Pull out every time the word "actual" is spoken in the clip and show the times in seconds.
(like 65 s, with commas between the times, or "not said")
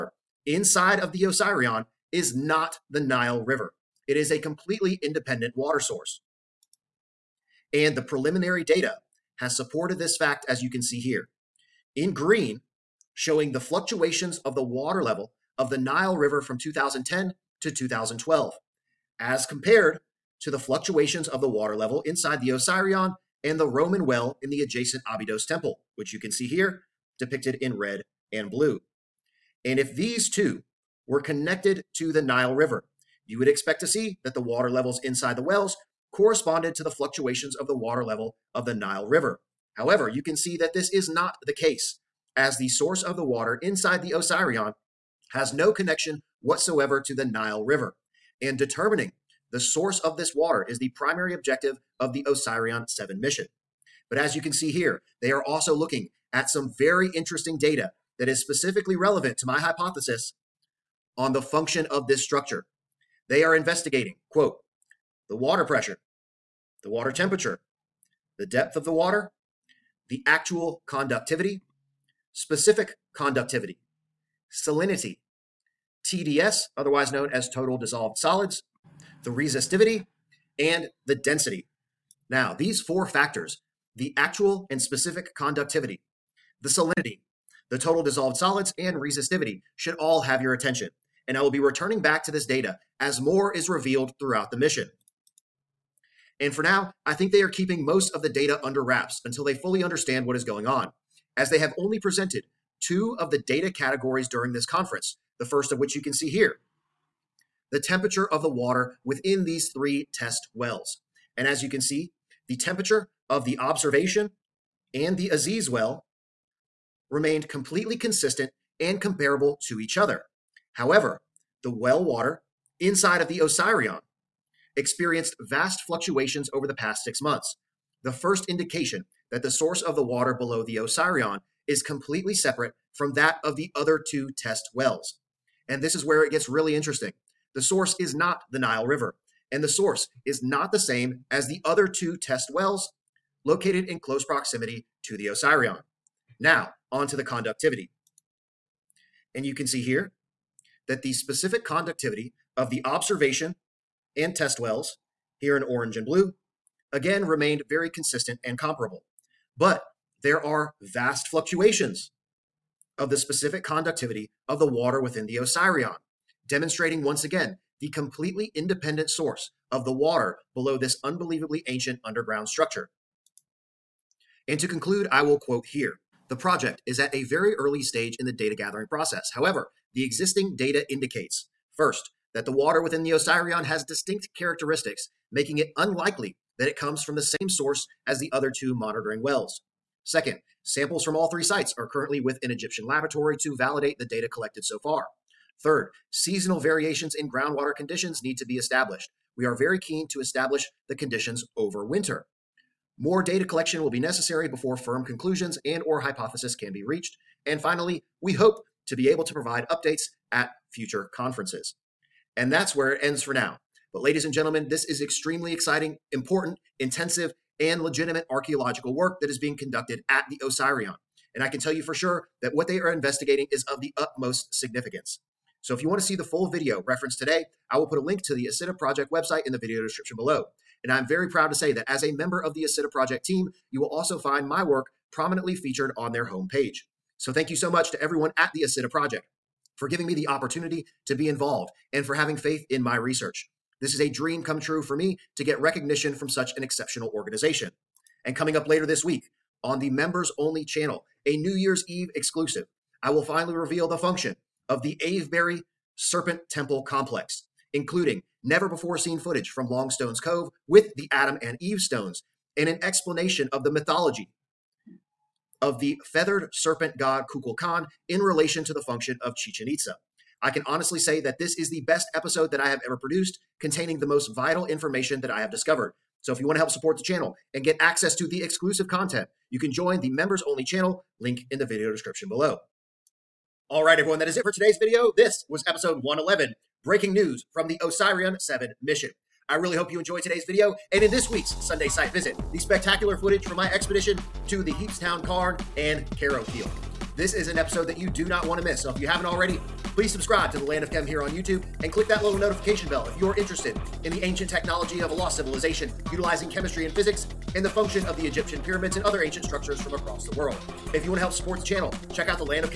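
70 s, 84 s.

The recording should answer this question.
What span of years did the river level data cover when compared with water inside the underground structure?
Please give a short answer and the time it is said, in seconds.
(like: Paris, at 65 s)
2010 to 2012, at 16 s.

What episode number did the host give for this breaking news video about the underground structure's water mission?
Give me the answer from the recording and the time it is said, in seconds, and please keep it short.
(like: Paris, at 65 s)
111, at 286 s.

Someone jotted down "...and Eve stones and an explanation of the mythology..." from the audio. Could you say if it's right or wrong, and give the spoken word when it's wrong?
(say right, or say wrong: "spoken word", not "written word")
right.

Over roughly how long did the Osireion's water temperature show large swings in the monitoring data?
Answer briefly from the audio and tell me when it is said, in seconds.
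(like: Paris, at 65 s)
6 months, at 127 s.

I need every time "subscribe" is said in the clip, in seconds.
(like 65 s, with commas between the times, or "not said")
300 s.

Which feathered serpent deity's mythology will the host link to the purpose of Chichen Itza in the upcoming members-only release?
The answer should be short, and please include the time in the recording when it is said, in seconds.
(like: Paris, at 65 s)
Kukulkan, at 267 s.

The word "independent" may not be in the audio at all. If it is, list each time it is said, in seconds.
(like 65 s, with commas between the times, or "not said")
5 s, 168 s.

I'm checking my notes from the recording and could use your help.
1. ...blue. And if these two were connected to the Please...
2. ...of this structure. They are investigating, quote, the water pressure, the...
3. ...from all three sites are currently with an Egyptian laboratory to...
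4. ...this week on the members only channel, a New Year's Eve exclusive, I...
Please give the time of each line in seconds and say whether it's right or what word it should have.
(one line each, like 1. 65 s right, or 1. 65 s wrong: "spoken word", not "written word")
1. 28 s wrong: "Nile", not "Please"
2. 61 s right
3. 191 s right
4. 248 s right.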